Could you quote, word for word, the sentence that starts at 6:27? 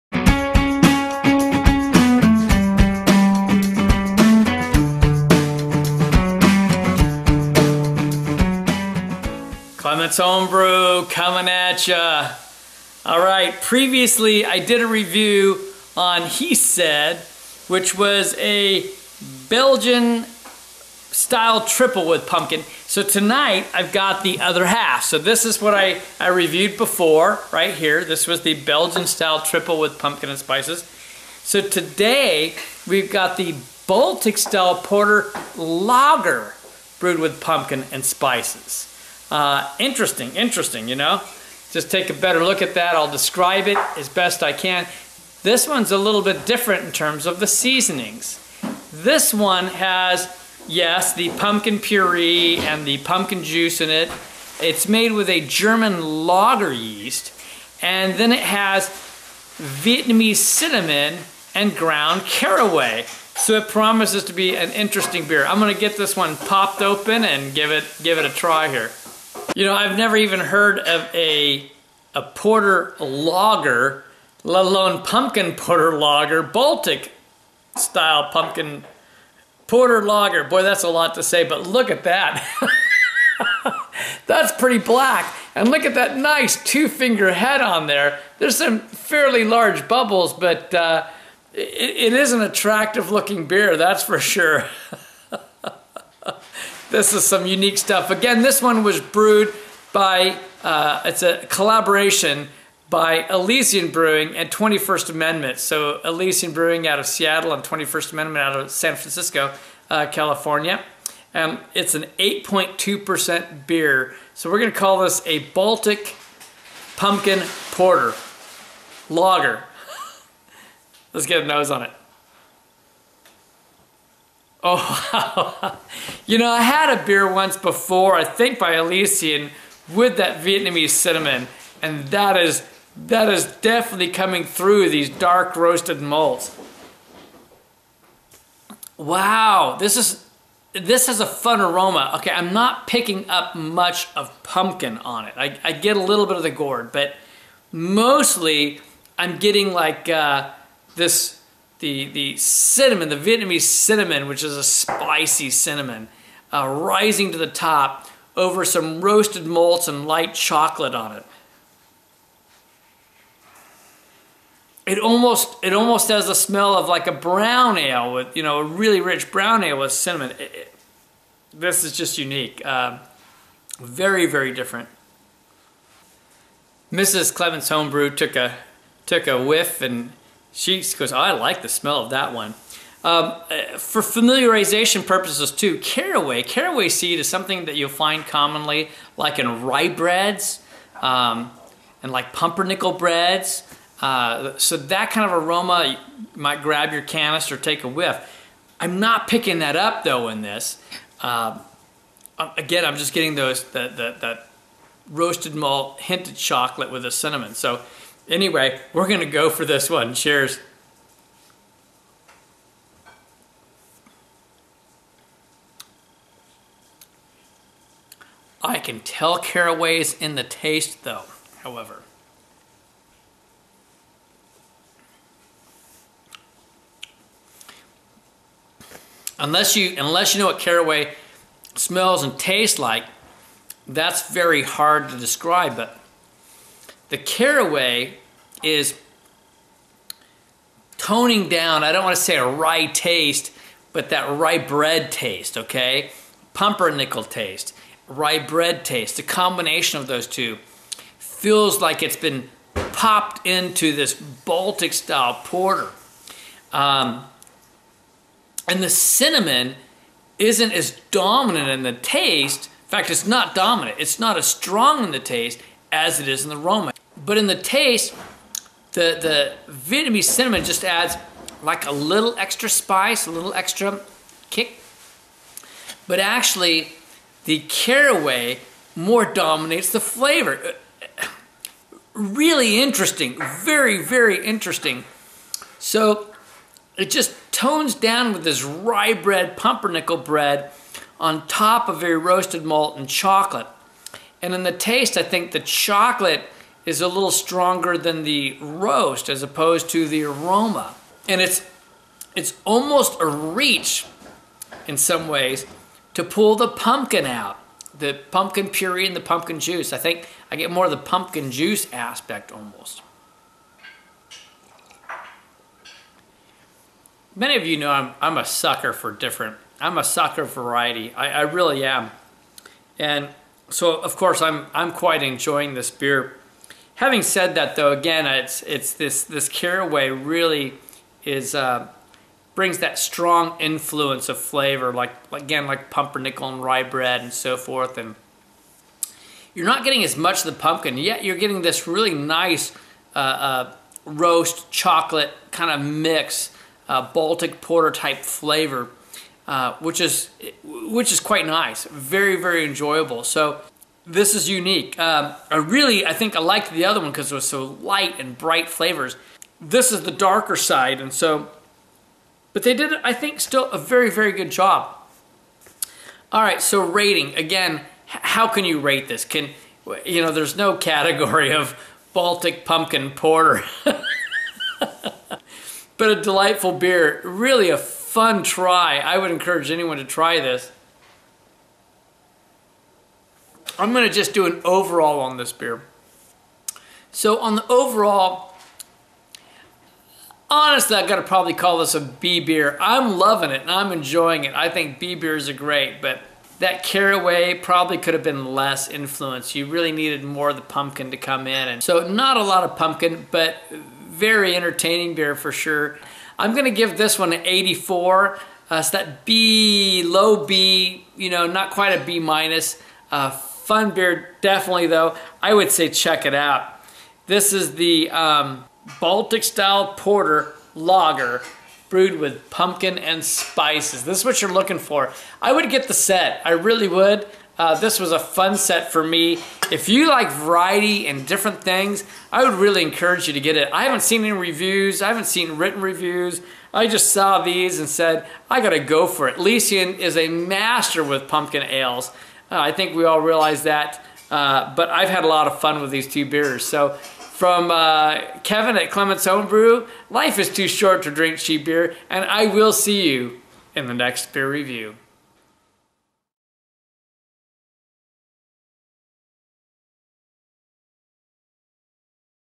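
So on the overall, honestly, I've got to probably call this a B beer.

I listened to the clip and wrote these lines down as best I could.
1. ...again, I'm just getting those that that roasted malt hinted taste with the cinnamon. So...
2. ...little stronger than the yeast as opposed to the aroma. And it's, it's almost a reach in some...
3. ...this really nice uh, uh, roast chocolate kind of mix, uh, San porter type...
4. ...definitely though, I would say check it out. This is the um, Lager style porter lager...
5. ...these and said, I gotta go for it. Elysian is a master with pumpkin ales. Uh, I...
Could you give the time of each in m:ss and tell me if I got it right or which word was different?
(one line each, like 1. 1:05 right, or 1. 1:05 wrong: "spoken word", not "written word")
1. 3:22 wrong: "chocolate", not "taste"
2. 4:57 wrong: "roast", not "yeast"
3. 5:41 wrong: "Baltic", not "San"
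4. 6:54 wrong: "Baltic", not "Lager"
5. 7:17 right.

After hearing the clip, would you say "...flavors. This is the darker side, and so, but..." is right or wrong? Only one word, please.
right.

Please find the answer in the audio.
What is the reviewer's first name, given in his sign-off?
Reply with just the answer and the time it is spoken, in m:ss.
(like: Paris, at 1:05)
Kevin, at 7:28.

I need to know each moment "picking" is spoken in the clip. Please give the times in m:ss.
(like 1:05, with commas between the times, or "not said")
2:22, 3:19.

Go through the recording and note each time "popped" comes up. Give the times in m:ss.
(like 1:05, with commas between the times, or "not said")
1:06, 4:12.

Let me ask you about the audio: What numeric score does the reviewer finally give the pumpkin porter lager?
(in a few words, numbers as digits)
84.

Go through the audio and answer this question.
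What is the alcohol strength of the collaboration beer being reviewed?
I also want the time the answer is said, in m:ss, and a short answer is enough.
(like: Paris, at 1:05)
8.2%, at 1:52.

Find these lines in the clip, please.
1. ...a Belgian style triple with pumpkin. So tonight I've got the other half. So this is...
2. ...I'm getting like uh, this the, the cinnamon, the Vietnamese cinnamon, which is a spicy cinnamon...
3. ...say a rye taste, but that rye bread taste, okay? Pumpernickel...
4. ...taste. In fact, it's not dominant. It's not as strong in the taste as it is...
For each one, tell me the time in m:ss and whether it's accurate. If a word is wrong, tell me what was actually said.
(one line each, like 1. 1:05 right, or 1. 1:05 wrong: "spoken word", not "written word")
1. 0:18 right
2. 2:29 right
3. 4:02 right
4. 4:21 right.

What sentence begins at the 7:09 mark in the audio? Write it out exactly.
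If you like variety and different things, I would really encourage you to get it.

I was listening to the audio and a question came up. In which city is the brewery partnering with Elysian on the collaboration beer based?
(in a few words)
San Francisco.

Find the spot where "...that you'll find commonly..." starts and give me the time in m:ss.
3:07.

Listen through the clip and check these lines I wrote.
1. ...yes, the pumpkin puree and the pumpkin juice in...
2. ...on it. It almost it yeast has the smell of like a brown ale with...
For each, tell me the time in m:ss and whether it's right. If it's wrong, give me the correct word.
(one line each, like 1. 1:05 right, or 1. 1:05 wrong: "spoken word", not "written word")
1. 0:50 right
2. 2:40 wrong: "almost", not "yeast".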